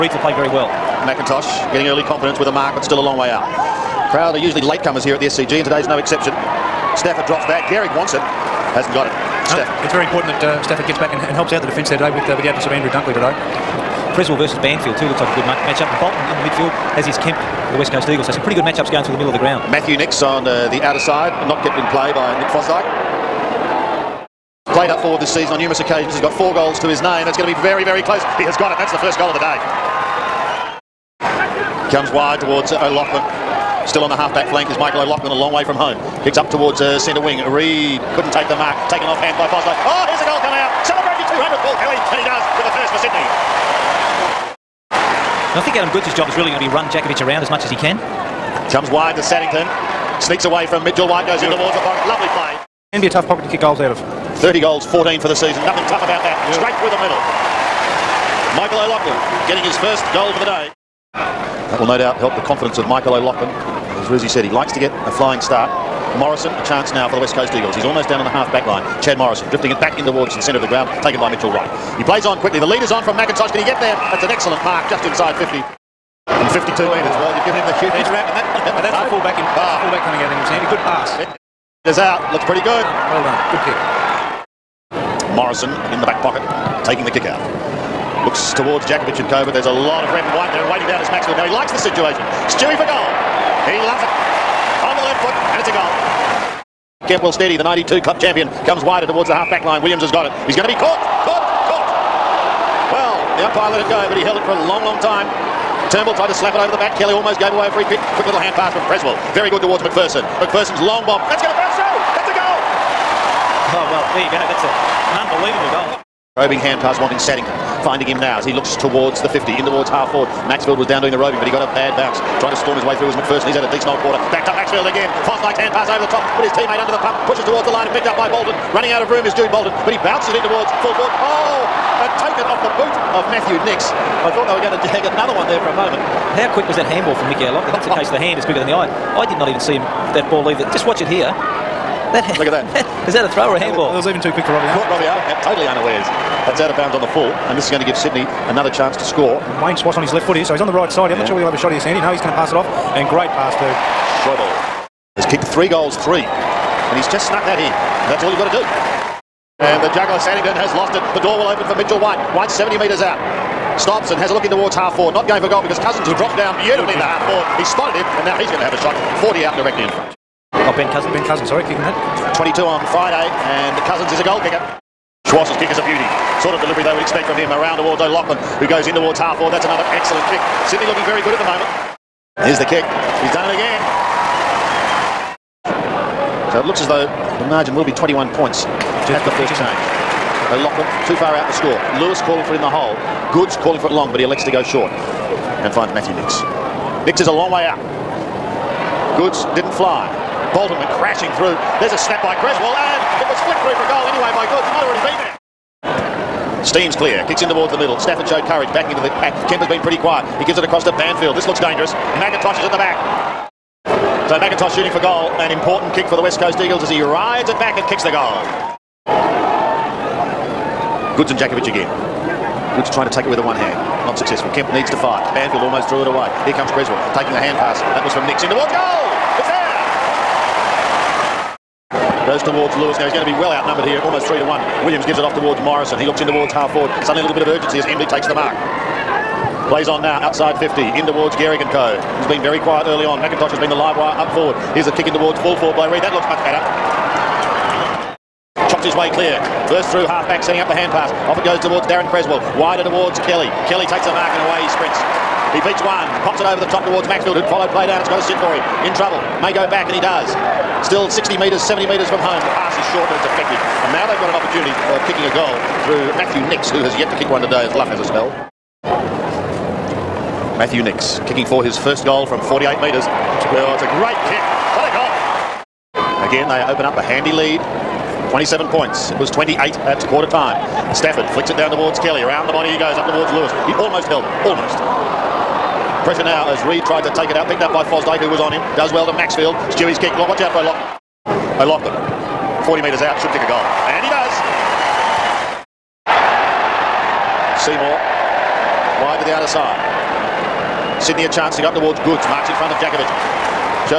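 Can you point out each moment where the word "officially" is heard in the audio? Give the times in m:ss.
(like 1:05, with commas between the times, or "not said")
not said.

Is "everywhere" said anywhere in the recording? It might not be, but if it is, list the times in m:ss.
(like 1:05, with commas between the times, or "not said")
not said.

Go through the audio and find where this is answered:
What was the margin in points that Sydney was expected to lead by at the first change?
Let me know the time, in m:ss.
3:07.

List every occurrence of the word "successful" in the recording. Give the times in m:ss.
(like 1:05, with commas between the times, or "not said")
3:44.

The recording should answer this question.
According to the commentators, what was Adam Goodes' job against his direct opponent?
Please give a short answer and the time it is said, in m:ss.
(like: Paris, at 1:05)
run Jakovich around, at 0:46.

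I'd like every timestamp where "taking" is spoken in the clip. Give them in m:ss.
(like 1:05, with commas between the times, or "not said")
1:26, 3:47.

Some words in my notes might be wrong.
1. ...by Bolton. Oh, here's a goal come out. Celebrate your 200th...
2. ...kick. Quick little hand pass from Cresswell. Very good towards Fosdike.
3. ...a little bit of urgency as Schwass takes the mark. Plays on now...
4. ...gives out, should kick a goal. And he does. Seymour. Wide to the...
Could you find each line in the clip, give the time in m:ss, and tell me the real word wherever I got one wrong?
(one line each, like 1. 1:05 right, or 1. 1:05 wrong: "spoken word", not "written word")
1. 0:39 wrong: "Fosler", not "Bolton"
2. 1:47 wrong: "McPherson", not "Fosdike"
3. 3:57 wrong: "Embley", not "Schwass"
4. 4:52 wrong: "metres", not "gives".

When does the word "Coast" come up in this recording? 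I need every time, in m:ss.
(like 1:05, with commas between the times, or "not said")
0:17, 1:07, 3:36.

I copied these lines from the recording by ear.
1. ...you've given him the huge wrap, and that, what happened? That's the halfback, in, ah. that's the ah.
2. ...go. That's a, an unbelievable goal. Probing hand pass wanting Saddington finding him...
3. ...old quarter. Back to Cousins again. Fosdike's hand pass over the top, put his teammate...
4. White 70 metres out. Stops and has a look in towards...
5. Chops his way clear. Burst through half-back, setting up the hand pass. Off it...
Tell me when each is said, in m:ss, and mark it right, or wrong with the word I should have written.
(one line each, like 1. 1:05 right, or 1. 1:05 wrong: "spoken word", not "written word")
1. 1:17 wrong: "fullback", not "halfback"
2. 1:54 right
3. 2:03 wrong: "Maxfield", not "Cousins"
4. 2:42 right
5. 4:08 right.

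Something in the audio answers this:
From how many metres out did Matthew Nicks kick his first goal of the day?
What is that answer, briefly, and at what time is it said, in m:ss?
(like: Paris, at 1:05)
48, at 4:32.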